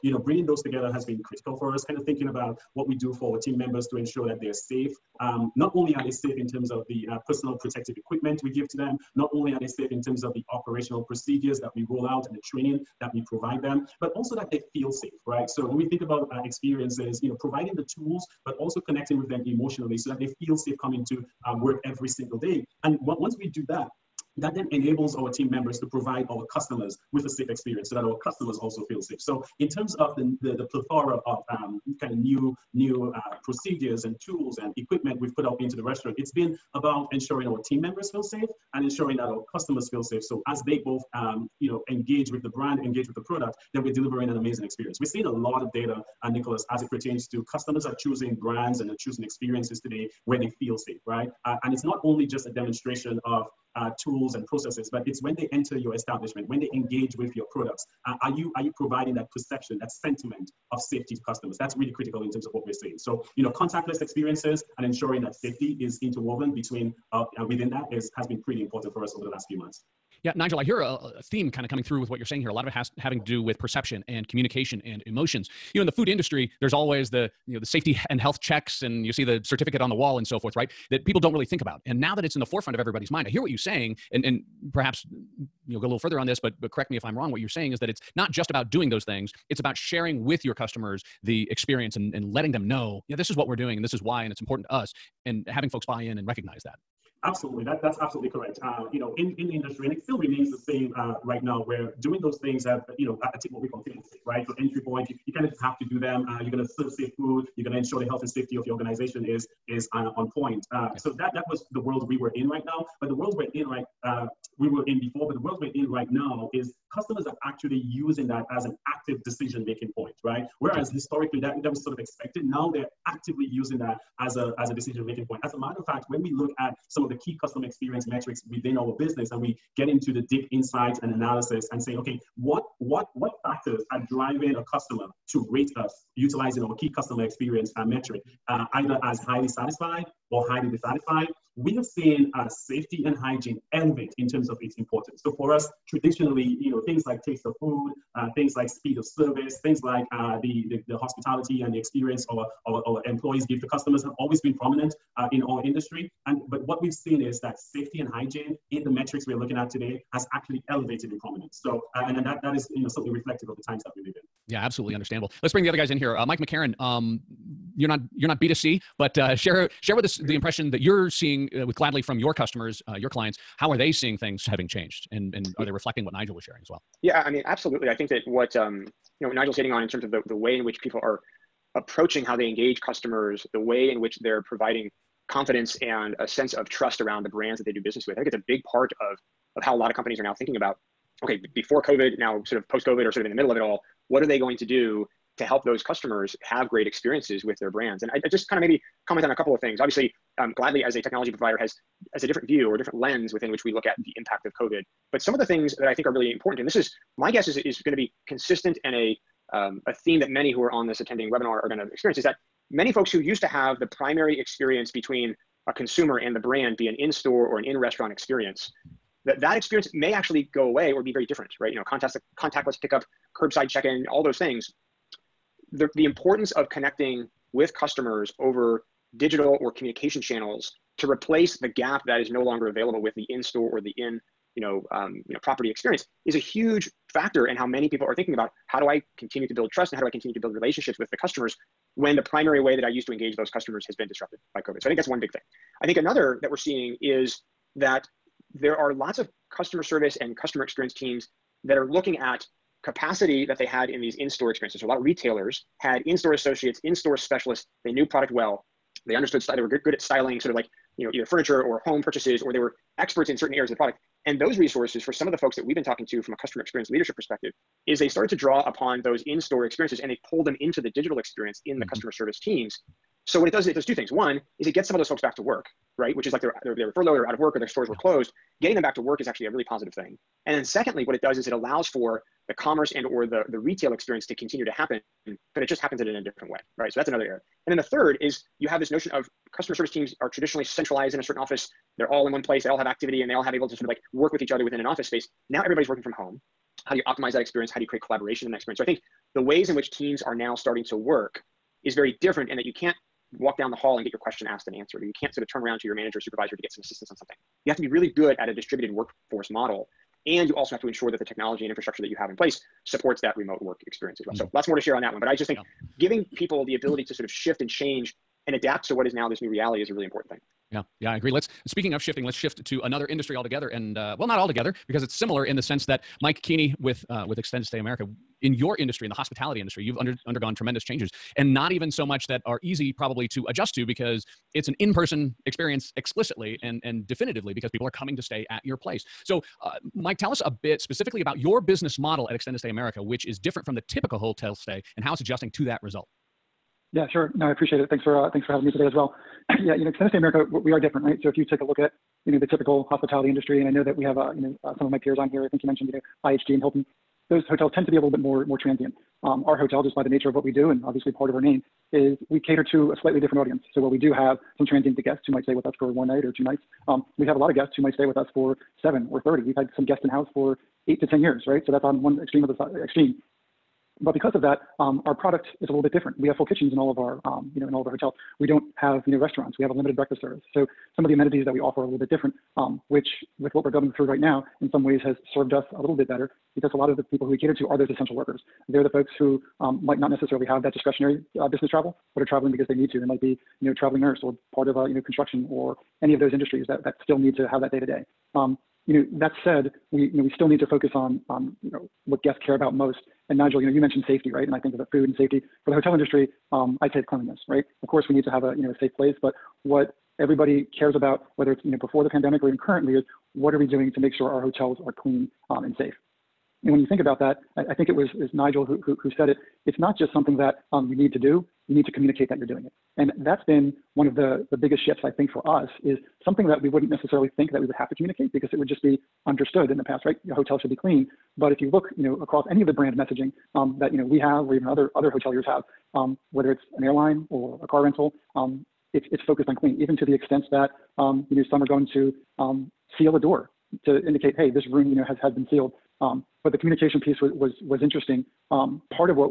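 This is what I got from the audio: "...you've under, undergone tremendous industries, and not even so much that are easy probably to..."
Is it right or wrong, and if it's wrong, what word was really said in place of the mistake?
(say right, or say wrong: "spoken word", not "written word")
wrong: "changes", not "industries".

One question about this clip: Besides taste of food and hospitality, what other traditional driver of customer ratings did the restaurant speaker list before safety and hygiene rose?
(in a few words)
speed of service.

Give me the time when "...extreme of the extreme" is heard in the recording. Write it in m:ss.
6:12.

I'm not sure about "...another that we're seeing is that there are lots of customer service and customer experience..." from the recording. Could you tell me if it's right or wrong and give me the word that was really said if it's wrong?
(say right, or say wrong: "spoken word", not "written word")
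right.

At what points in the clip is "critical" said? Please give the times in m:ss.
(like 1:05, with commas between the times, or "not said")
0:01, 1:01.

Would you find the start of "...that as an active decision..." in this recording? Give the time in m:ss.
1:58.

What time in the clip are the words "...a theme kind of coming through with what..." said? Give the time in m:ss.
1:10.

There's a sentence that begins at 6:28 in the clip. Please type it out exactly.
They're the folks who um, might not necessarily have that discretionary uh, business travel, but are traveling because they need to.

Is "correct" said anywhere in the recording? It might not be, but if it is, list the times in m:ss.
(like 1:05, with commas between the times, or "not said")
1:26, 1:38.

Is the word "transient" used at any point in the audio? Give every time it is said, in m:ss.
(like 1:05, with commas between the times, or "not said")
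5:58, 6:04.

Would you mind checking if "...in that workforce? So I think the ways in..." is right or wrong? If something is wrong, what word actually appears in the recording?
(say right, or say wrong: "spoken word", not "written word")
wrong: "experience", not "workforce".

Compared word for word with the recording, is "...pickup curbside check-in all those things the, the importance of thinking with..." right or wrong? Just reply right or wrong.
wrong.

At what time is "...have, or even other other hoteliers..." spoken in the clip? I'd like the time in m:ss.
7:14.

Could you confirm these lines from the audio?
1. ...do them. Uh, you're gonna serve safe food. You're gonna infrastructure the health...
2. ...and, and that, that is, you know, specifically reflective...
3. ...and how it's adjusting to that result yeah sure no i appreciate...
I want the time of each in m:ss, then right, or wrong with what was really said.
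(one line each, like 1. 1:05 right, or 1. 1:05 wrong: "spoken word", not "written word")
1. 1:45 wrong: "ensure", not "infrastructure"
2. 2:42 wrong: "certainly", not "specifically"
3. 5:44 right.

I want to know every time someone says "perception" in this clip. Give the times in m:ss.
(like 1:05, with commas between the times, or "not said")
0:59, 1:13.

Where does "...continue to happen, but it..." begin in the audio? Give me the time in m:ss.
4:44.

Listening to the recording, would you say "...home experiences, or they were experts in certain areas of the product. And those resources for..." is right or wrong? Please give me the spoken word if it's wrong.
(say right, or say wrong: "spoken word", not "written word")
wrong: "purchases", not "experiences".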